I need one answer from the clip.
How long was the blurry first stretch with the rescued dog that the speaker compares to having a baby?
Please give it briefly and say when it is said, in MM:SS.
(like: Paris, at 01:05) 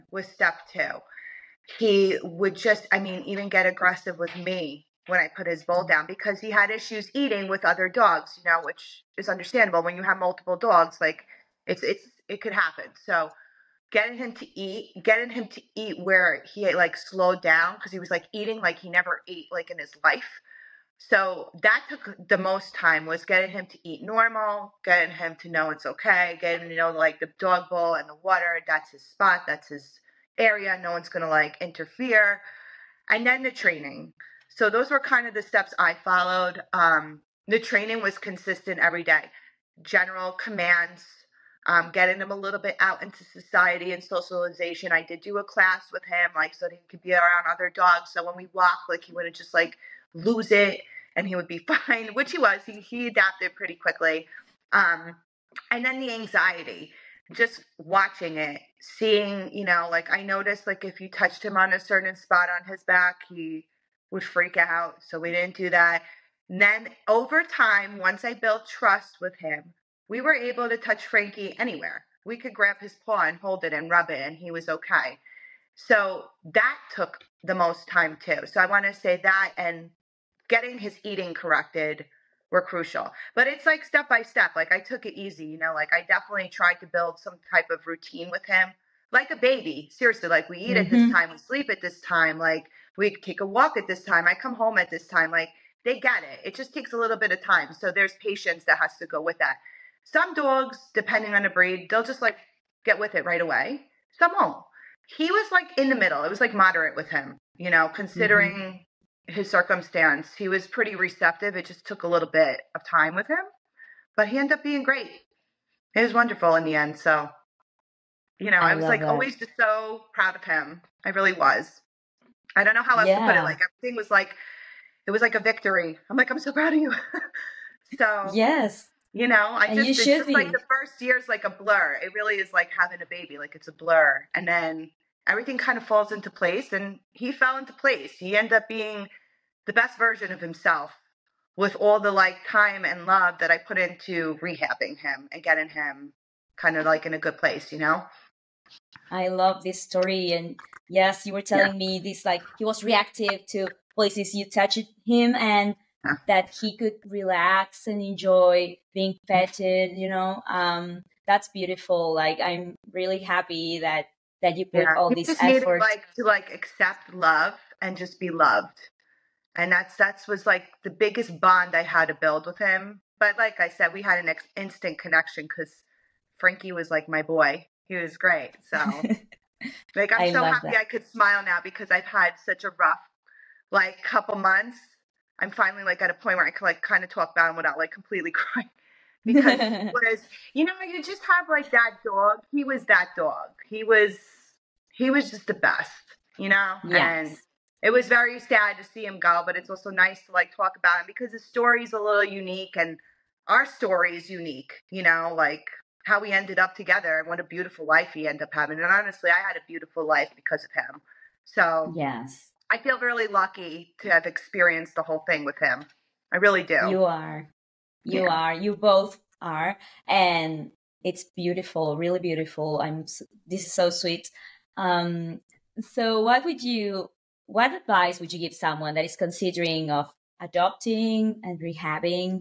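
The first year, at 02:10.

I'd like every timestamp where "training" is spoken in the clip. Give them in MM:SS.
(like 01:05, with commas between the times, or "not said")
00:33, 00:37.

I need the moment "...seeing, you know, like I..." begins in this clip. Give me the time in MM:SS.
00:58.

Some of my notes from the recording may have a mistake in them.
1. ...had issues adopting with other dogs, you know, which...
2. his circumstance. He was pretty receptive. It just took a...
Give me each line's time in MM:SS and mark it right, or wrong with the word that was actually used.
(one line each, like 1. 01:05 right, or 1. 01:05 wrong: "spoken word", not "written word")
1. 00:06 wrong: "eating", not "adopting"
2. 01:49 right.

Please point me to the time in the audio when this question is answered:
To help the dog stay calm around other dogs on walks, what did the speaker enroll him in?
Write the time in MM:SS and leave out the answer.
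00:45.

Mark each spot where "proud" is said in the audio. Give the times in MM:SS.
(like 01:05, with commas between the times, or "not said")
02:00, 02:06.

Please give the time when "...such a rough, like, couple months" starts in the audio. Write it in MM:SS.
03:02.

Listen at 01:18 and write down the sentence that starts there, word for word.
So I want to say that and getting his eating corrected were crucial.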